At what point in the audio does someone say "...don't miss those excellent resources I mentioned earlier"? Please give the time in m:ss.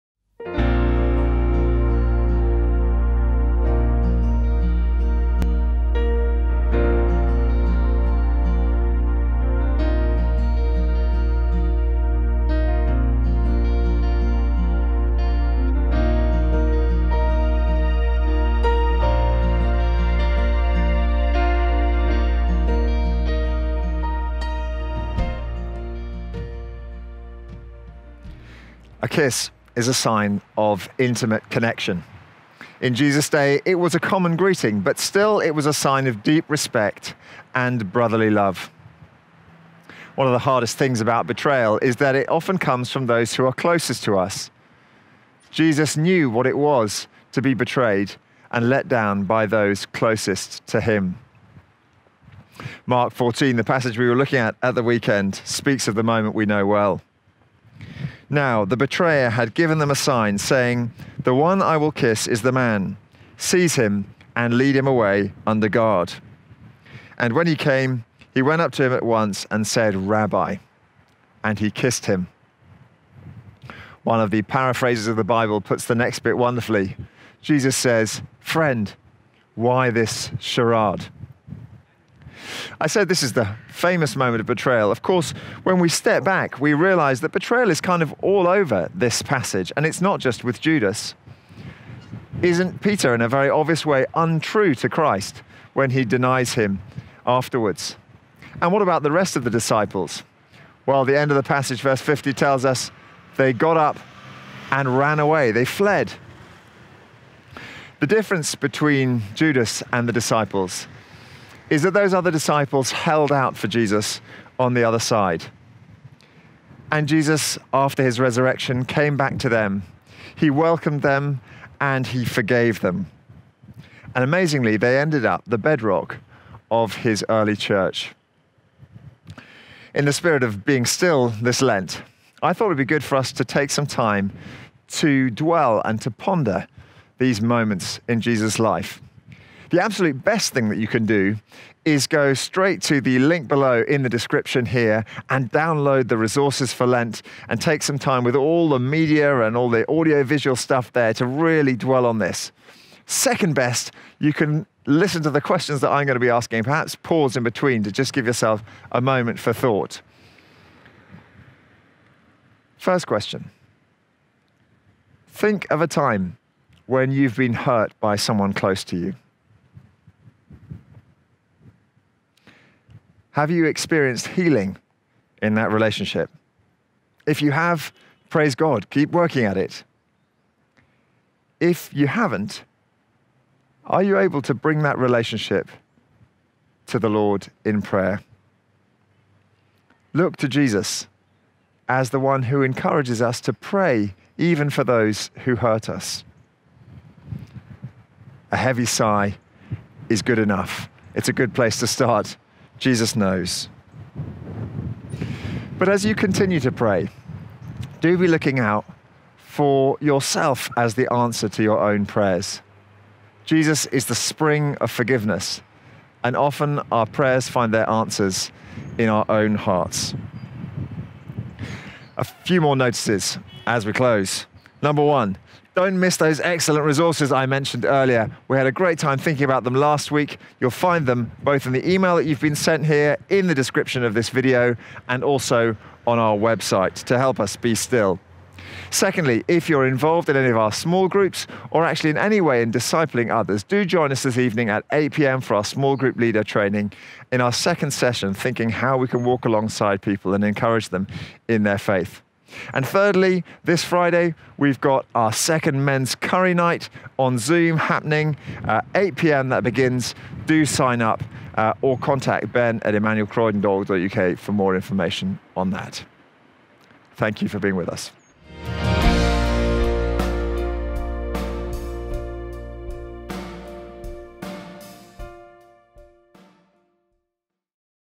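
3:45.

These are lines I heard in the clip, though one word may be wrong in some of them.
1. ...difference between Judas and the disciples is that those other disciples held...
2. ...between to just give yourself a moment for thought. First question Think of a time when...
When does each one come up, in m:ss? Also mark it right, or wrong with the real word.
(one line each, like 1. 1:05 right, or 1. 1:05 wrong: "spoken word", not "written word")
1. 1:48 right
2. 2:37 right.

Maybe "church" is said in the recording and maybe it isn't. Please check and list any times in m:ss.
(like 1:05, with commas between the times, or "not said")
2:07.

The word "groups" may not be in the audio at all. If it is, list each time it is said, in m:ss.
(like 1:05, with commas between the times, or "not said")
4:01, 4:05.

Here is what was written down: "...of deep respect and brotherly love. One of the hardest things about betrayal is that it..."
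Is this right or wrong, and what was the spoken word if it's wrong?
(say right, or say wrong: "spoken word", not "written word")
right.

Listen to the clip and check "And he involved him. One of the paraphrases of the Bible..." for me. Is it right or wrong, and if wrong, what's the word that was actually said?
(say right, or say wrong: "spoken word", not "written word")
wrong: "kissed", not "involved".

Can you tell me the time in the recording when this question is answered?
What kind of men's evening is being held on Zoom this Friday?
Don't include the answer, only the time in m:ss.
4:16.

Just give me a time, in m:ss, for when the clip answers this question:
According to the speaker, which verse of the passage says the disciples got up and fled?
1:41.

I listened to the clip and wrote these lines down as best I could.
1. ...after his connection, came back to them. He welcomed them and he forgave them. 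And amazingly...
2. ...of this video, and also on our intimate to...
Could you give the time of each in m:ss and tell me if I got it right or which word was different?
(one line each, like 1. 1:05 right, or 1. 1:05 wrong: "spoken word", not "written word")
1. 1:57 wrong: "resurrection", not "connection"
2. 3:54 wrong: "website", not "intimate".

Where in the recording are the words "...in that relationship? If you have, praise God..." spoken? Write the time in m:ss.
2:55.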